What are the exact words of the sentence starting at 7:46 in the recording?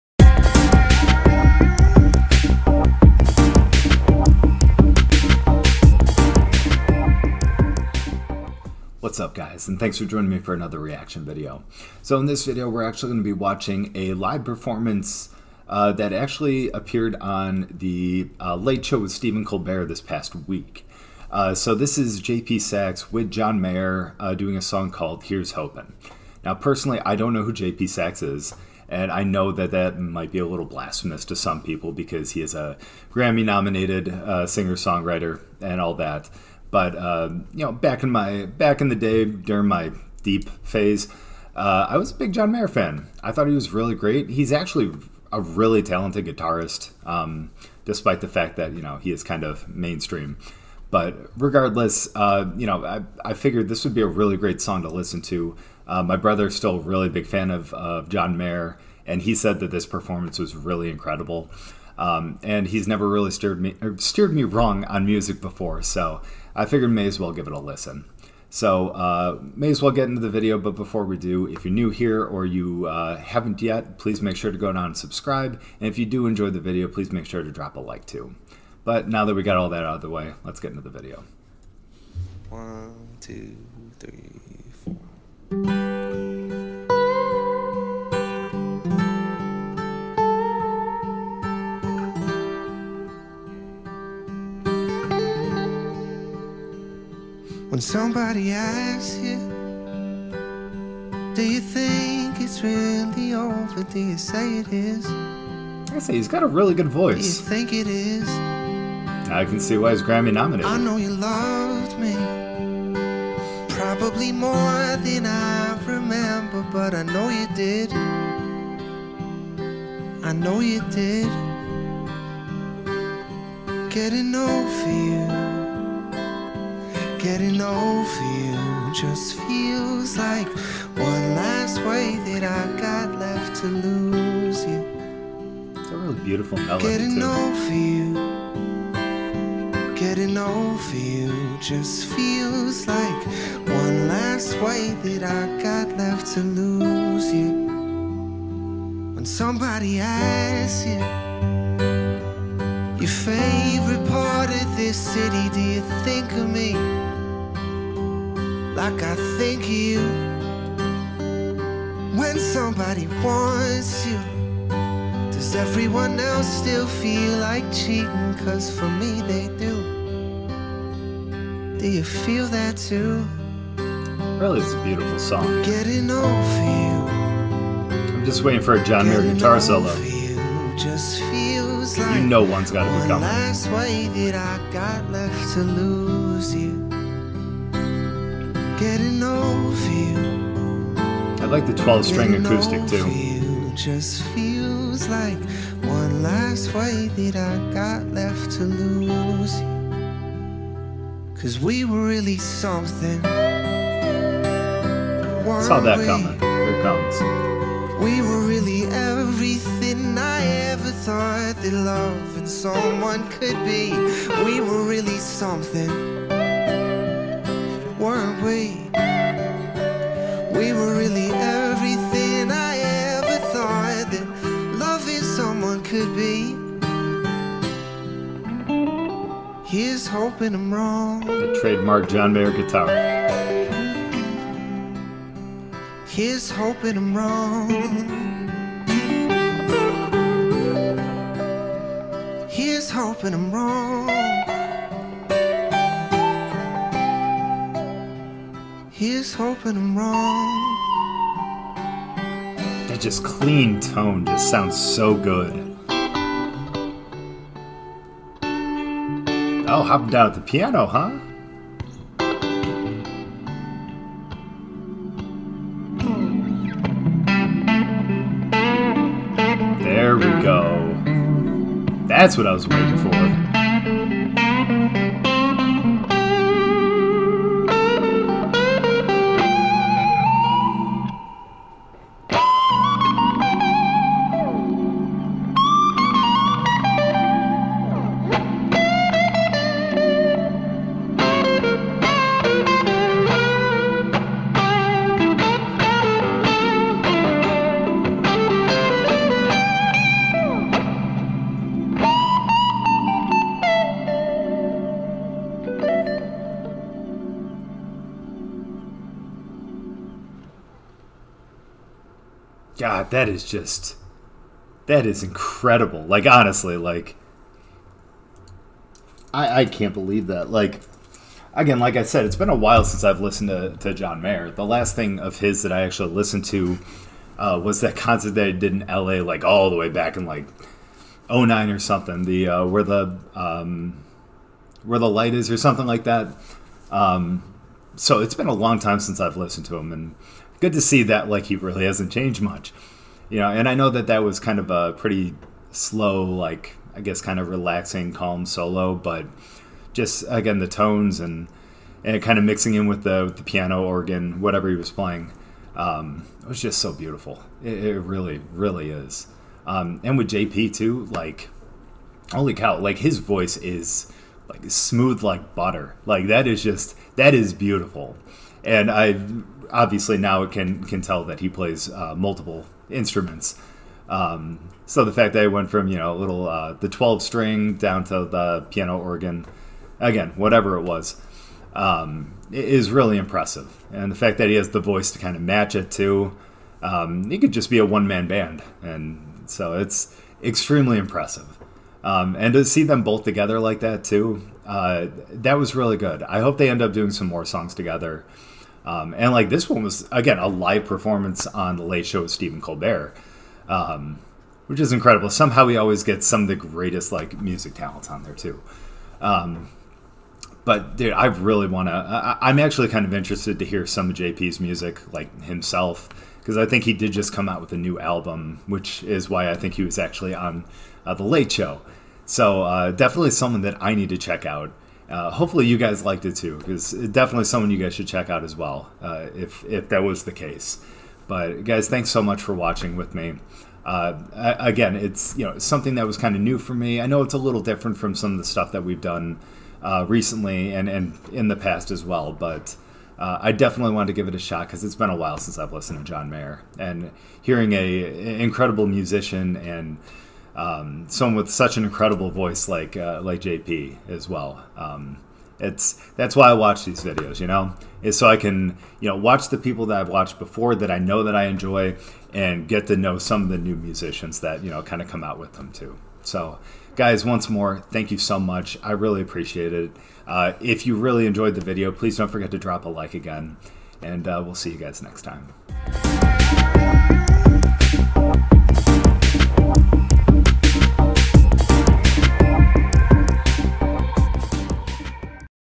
So, guys, once more, thank you so much.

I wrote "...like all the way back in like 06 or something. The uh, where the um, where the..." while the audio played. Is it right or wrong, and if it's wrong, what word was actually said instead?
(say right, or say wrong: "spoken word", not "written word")
wrong: "09", not "06".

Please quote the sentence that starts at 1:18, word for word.
But now that we got all that out of the way, let's get into the video.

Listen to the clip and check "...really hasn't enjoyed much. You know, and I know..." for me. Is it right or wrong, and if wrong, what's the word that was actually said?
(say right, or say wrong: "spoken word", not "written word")
wrong: "changed", not "enjoyed".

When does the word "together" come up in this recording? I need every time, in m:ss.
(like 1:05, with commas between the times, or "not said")
6:33, 6:37.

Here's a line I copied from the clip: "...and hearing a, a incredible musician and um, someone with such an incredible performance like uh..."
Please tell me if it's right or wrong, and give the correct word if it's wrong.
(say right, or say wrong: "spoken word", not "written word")
wrong: "voice", not "performance".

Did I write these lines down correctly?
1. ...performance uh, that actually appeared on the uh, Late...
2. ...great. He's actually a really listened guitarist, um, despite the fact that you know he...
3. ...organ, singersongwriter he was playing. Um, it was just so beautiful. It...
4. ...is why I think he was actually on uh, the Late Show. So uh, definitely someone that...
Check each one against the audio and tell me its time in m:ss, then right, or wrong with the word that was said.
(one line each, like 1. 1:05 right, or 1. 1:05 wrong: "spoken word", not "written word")
1. 0:14 right
2. 0:43 wrong: "talented", not "listened"
3. 5:53 wrong: "whatever", not "singersongwriter"
4. 6:59 right.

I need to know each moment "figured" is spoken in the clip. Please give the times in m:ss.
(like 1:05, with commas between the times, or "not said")
0:53, 1:06.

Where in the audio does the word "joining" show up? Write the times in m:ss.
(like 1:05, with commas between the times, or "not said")
0:10.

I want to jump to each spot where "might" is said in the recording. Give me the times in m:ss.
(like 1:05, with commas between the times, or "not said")
0:29.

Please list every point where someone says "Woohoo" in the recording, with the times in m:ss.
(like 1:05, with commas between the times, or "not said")
not said.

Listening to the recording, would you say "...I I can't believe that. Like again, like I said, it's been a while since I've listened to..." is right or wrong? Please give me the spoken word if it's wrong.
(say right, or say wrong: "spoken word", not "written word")
right.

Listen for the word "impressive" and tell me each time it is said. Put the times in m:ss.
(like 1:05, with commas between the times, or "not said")
6:23, 6:30.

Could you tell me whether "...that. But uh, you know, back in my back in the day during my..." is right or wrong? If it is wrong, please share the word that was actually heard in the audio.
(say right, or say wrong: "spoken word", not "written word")
right.